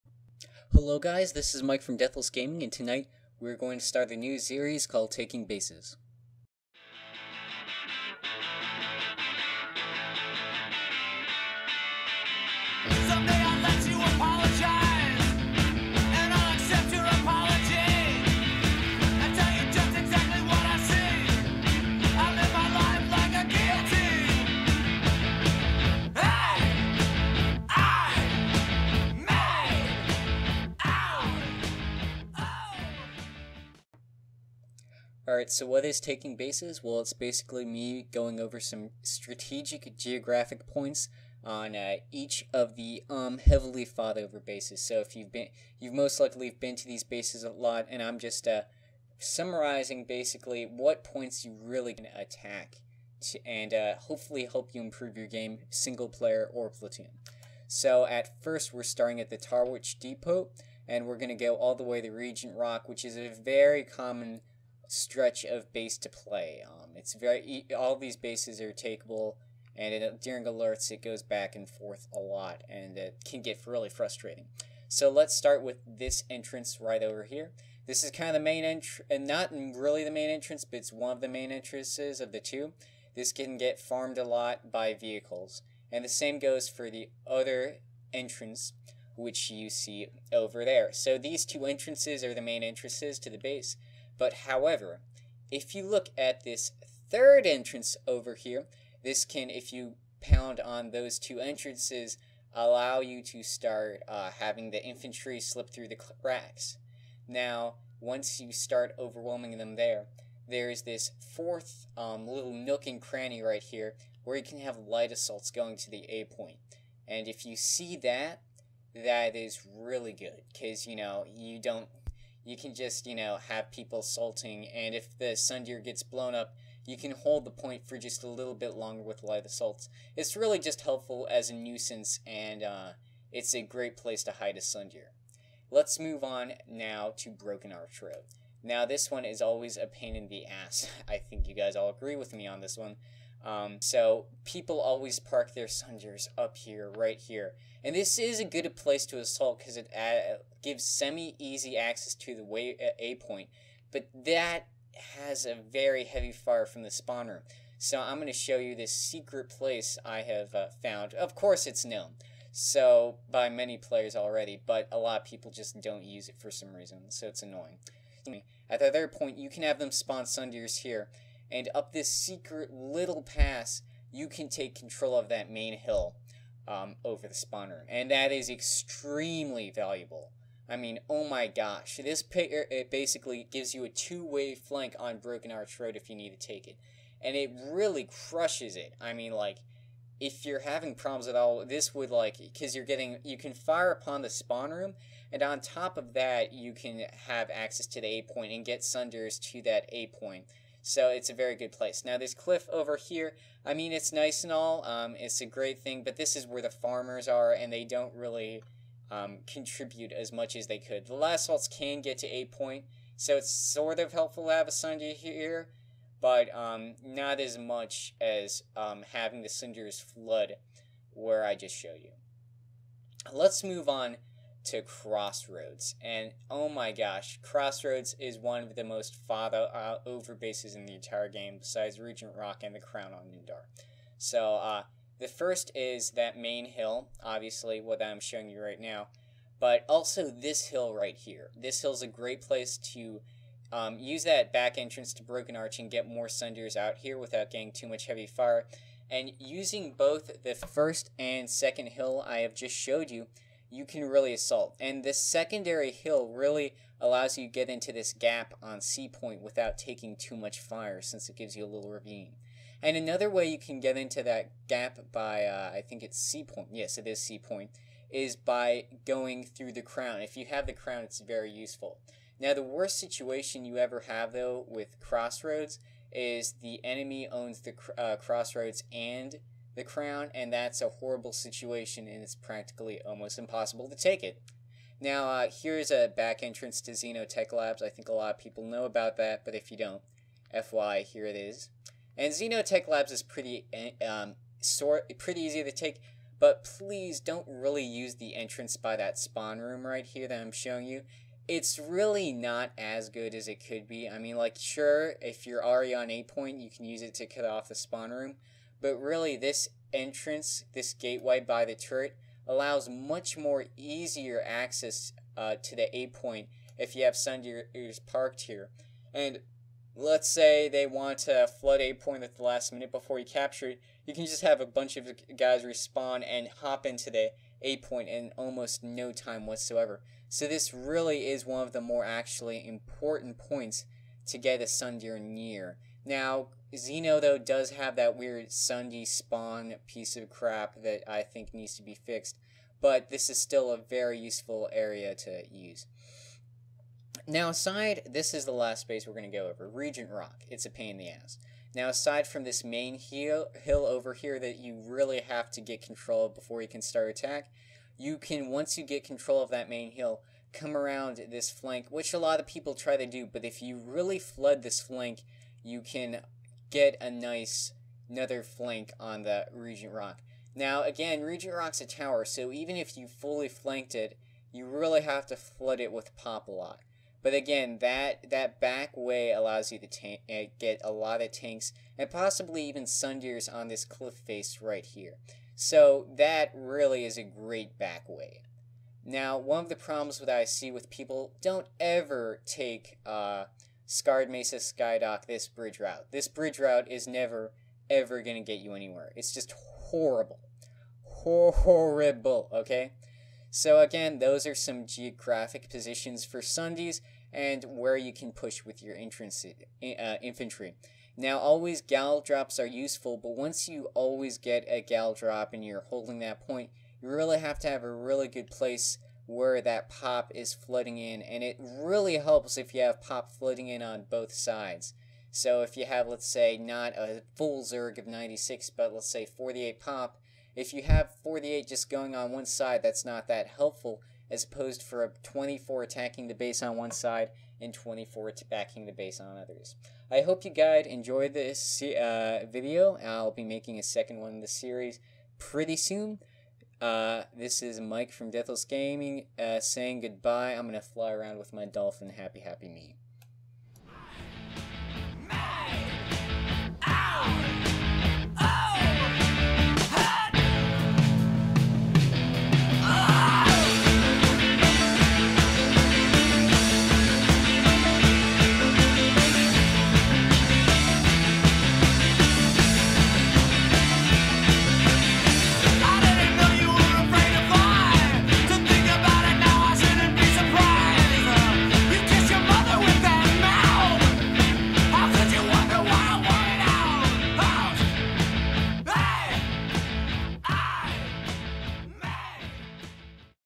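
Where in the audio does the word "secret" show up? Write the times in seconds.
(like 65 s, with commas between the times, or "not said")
158 s, 172 s.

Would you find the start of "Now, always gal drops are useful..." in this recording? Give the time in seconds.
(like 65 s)
411 s.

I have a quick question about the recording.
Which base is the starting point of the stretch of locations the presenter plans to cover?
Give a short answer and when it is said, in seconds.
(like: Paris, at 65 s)
Tarwich Depot, at 59 s.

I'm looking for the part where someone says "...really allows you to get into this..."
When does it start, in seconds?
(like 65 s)
256 s.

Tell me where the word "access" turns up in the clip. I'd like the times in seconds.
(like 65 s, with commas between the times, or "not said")
151 s, 197 s, 314 s.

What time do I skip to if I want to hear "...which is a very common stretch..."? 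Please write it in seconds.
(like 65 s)
62 s.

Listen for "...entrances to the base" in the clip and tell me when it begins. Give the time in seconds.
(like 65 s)
92 s.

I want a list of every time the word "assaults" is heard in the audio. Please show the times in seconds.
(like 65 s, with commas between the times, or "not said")
115 s, 129 s, 149 s, 254 s.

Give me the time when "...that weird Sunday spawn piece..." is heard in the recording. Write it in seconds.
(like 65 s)
337 s.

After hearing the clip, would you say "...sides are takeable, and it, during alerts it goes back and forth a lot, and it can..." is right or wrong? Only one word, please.
wrong.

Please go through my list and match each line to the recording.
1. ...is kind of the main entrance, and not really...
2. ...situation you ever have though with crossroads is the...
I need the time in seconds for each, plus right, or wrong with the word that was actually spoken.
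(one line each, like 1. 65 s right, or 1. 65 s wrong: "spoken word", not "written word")
1. 78 s right
2. 272 s right.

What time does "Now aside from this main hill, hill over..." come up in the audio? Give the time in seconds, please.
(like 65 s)
351 s.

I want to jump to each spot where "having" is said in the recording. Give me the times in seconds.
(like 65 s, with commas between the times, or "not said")
104 s, 190 s, 219 s.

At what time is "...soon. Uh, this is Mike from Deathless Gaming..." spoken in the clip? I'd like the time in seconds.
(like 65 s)
445 s.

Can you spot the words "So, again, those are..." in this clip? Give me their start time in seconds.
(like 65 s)
403 s.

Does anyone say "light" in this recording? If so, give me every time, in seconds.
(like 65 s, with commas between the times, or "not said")
114 s, 129 s.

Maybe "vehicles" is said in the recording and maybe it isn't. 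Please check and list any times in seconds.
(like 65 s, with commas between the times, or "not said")
84 s.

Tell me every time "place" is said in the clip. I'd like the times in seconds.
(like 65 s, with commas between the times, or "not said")
133 s, 148 s, 159 s, 201 s, 242 s, 418 s.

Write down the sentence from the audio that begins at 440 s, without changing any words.
I hope you guys enjoyed this uh, video.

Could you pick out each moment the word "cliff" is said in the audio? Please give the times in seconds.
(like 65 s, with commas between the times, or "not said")
202 s, 383 s.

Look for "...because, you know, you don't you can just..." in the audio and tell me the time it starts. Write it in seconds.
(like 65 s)
120 s.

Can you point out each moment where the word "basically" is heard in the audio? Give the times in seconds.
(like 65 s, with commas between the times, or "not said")
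37 s, 50 s, 182 s.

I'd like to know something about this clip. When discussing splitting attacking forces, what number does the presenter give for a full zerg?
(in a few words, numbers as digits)
96.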